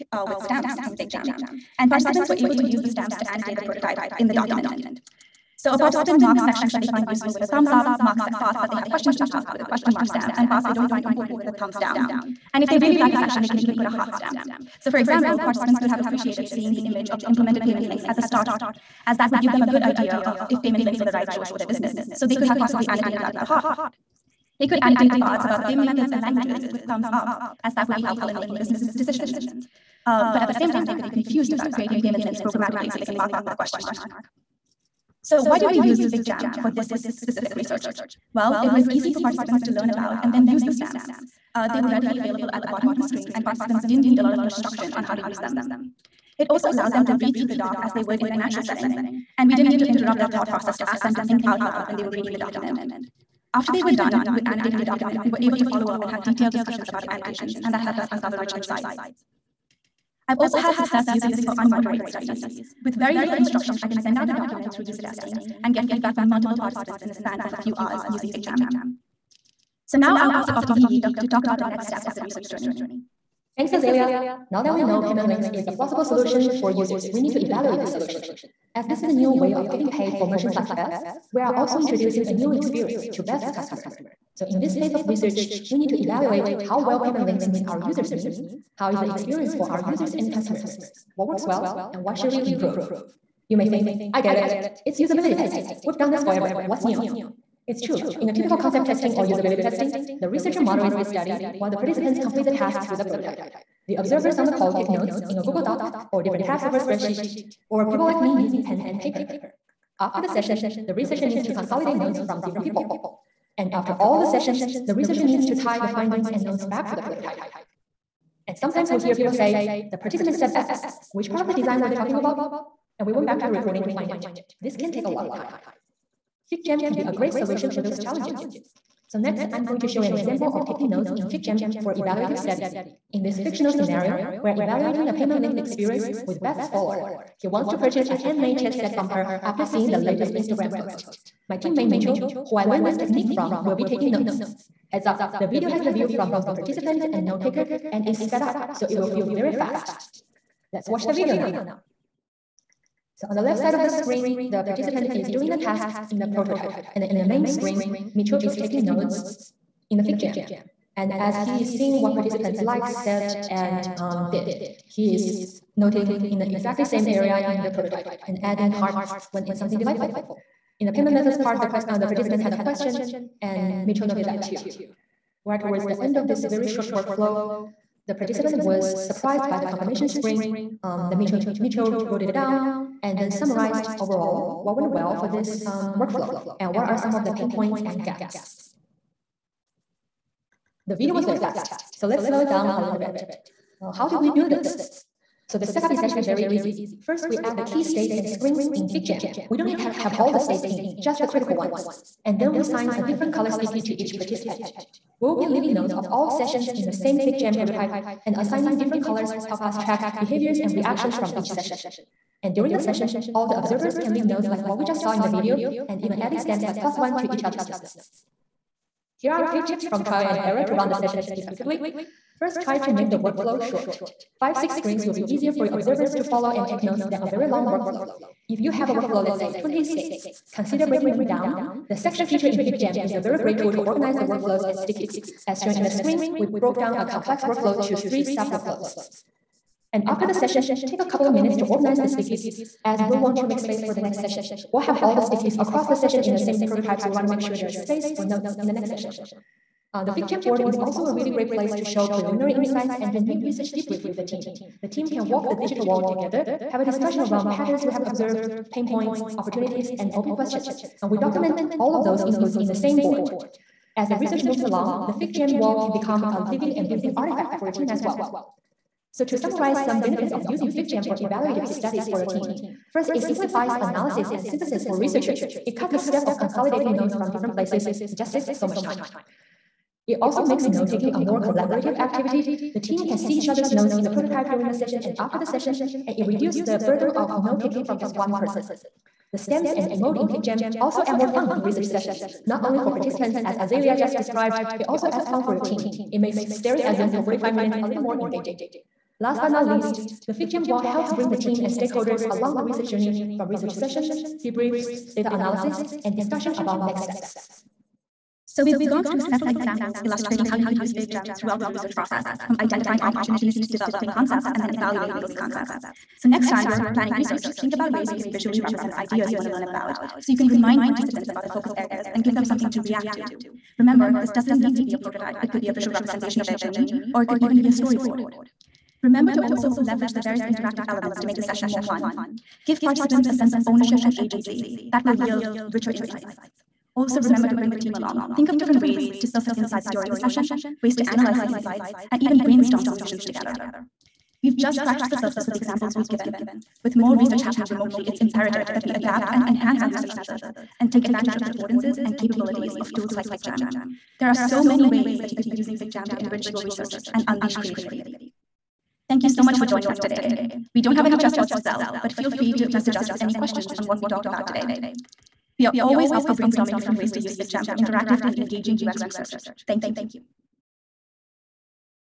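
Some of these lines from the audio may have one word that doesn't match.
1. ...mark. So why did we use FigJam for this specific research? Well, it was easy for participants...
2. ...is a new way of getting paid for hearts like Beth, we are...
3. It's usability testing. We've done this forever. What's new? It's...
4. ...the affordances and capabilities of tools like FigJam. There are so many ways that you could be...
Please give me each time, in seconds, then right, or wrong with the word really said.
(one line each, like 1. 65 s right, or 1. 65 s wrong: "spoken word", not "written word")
1. 33 s right
2. 79 s wrong: "merchants", not "hearts"
3. 94 s right
4. 351 s right.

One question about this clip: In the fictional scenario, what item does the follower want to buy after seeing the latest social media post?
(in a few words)
Handmade chess set.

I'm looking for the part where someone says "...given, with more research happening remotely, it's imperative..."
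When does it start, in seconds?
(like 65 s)
346 s.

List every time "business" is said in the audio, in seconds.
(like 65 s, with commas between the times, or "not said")
21 s, 28 s.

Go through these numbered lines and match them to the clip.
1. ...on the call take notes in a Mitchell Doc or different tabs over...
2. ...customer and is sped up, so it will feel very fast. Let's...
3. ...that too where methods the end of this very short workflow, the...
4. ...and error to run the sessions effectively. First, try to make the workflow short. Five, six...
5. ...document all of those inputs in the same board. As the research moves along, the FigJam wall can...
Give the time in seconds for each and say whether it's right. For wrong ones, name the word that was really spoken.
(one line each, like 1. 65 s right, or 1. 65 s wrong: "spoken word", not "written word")
1. 104 s wrong: "Google", not "Mitchell"
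2. 147 s wrong: "taker", not "customer"
3. 174 s wrong: "towards", not "methods"
4. 220 s right
5. 261 s right.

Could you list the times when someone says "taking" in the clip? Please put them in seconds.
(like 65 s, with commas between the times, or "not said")
130 s, 143 s, 158 s, 280 s, 287 s.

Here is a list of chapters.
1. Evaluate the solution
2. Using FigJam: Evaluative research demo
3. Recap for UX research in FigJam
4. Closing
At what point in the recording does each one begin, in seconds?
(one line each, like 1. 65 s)
1. 84 s
2. 129 s
3. 308 s
4. 359 s.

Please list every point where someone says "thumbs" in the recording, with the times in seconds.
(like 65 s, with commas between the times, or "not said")
7 s, 11 s, 26 s.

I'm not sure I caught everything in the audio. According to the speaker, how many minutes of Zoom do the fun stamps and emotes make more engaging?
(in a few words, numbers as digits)
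45.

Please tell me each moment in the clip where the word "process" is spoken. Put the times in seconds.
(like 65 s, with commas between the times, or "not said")
50 s, 311 s.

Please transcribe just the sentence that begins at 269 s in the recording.
So to summarize some benefits of using FigJam for evaluative studies for your team, First, it simplifies analysis and synthesis for researchers.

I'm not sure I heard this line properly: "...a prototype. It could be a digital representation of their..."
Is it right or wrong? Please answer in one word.
wrong.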